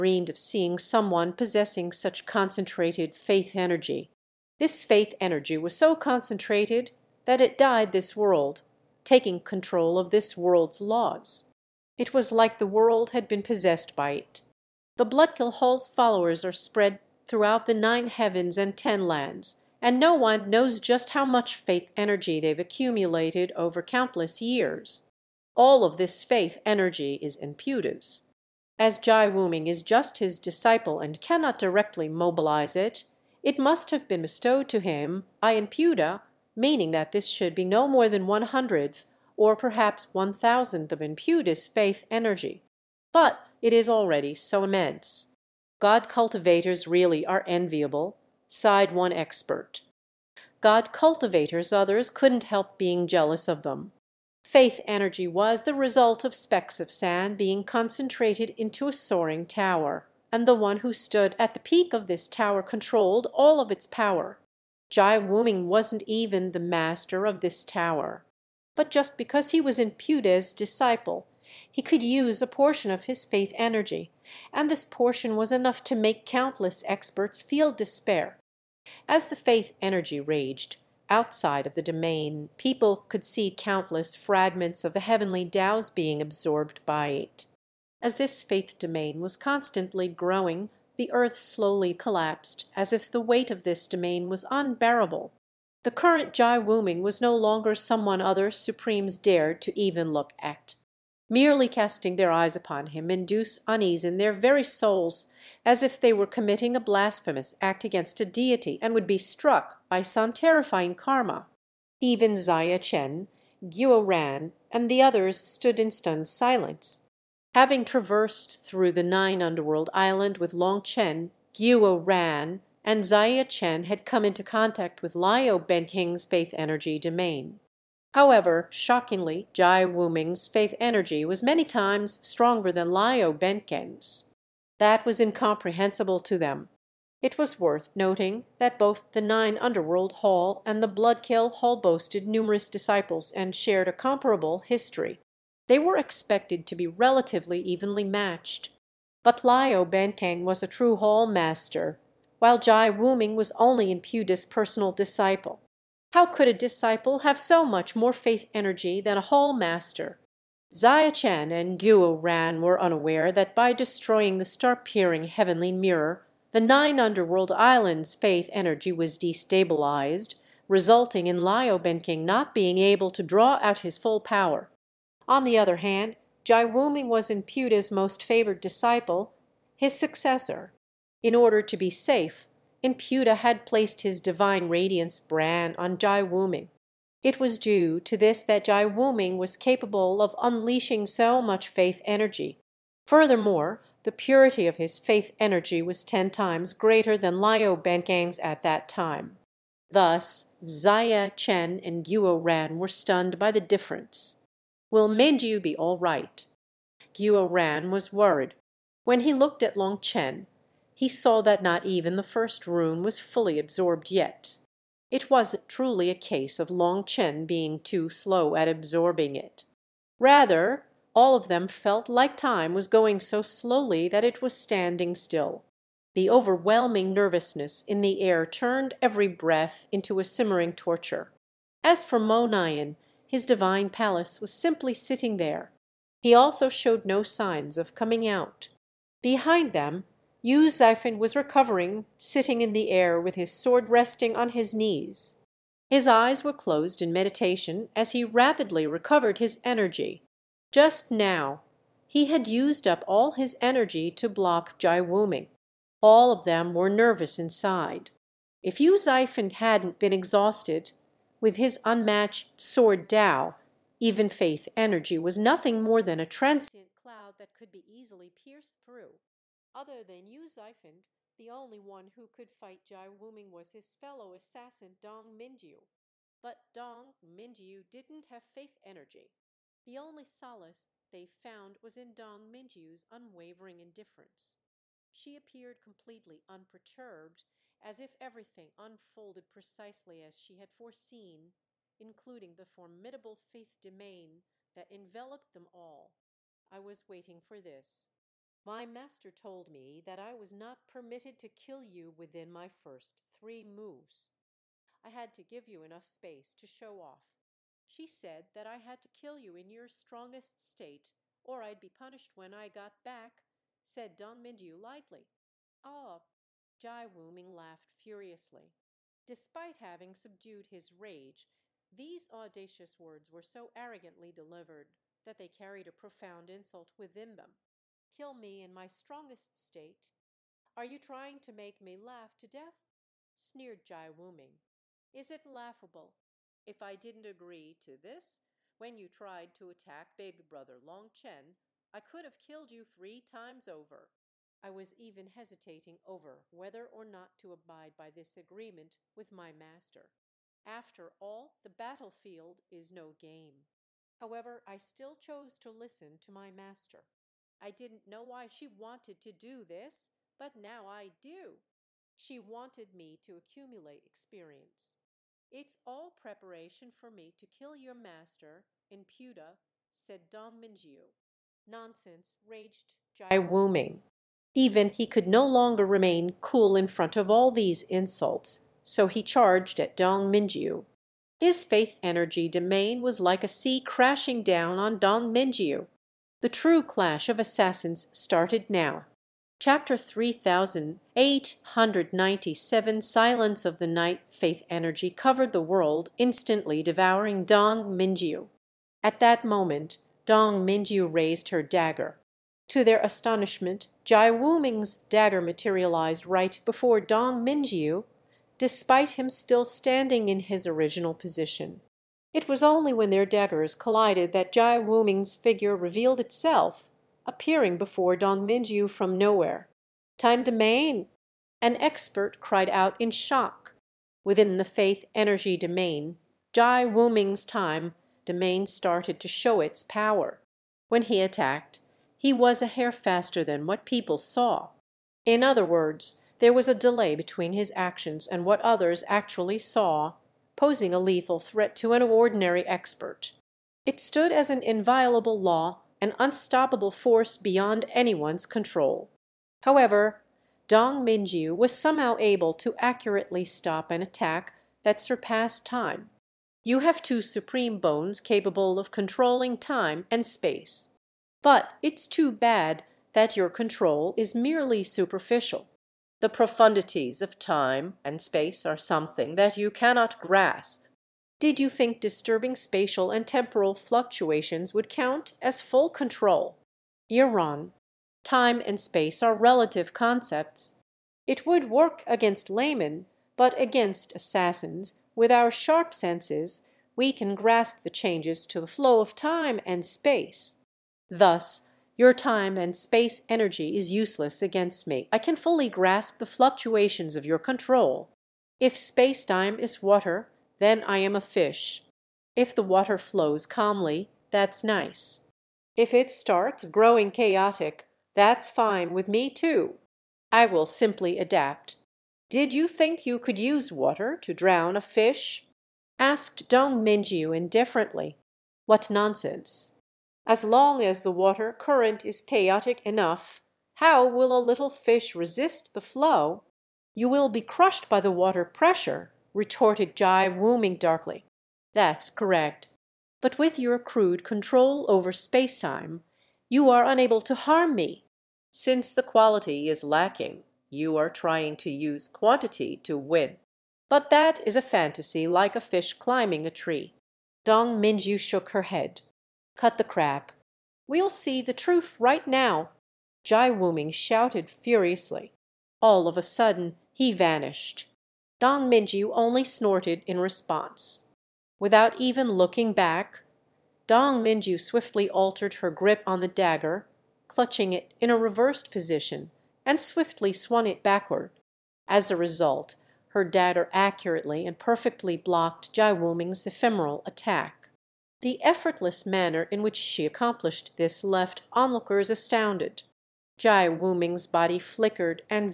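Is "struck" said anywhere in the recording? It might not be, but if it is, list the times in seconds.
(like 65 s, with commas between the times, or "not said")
109 s.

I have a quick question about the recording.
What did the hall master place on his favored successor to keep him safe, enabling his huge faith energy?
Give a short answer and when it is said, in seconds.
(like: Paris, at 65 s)
divine radiance brand, at 184 s.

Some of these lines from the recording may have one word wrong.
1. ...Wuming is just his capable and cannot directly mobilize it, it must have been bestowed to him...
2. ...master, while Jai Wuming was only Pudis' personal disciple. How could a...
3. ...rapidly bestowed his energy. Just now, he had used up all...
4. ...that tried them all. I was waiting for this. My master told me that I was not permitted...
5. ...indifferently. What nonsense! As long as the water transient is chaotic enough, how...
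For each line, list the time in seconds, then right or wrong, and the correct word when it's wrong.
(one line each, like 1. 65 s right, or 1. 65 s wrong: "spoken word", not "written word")
1. 29 s wrong: "disciple", not "capable"
2. 151 s right
3. 248 s wrong: "recovered", not "bestowed"
4. 294 s wrong: "enveloped", not "tried"
5. 517 s wrong: "current", not "transient".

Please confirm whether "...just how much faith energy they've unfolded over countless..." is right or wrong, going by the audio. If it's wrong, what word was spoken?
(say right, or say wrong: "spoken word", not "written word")
wrong: "accumulated", not "unfolded".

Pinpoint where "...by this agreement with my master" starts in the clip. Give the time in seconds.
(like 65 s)
347 s.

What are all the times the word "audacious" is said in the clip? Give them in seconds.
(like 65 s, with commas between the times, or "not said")
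322 s.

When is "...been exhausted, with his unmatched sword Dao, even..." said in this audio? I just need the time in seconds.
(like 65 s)
259 s.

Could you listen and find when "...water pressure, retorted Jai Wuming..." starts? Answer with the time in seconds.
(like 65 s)
528 s.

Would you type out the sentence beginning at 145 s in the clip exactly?
They were expected to be relatively evenly matched.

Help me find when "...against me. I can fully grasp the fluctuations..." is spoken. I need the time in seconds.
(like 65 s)
494 s.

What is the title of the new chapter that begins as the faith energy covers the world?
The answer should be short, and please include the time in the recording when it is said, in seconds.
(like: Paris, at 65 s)
Silence of the night, at 393 s.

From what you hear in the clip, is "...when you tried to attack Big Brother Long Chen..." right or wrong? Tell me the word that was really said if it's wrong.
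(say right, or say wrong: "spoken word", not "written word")
right.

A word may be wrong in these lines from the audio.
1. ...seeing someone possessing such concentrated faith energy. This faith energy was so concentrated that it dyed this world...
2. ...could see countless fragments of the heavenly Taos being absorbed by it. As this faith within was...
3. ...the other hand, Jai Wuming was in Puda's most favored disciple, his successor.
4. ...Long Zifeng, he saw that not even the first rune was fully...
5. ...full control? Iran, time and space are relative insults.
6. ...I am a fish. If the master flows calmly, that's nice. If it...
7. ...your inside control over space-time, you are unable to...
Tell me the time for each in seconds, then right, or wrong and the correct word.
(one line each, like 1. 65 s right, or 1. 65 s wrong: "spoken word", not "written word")
1. 0 s right
2. 83 s wrong: "domain", not "within"
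3. 175 s right
4. 209 s wrong: "Chen", not "Zifeng"
5. 475 s wrong: "concepts", not "insults"
6. 500 s wrong: "water", not "master"
7. 533 s wrong: "crude", not "inside".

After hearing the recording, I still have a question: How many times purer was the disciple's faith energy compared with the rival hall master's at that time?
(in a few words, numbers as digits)
10.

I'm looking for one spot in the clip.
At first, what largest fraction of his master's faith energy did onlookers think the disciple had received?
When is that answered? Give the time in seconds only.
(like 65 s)
38 s.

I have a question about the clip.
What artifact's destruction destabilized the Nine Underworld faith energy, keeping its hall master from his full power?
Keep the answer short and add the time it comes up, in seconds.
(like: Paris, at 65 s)
star-peering heavenly mirror, at 164 s.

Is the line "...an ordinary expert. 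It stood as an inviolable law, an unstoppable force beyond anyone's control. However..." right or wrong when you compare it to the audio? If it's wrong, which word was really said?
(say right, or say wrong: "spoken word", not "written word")
right.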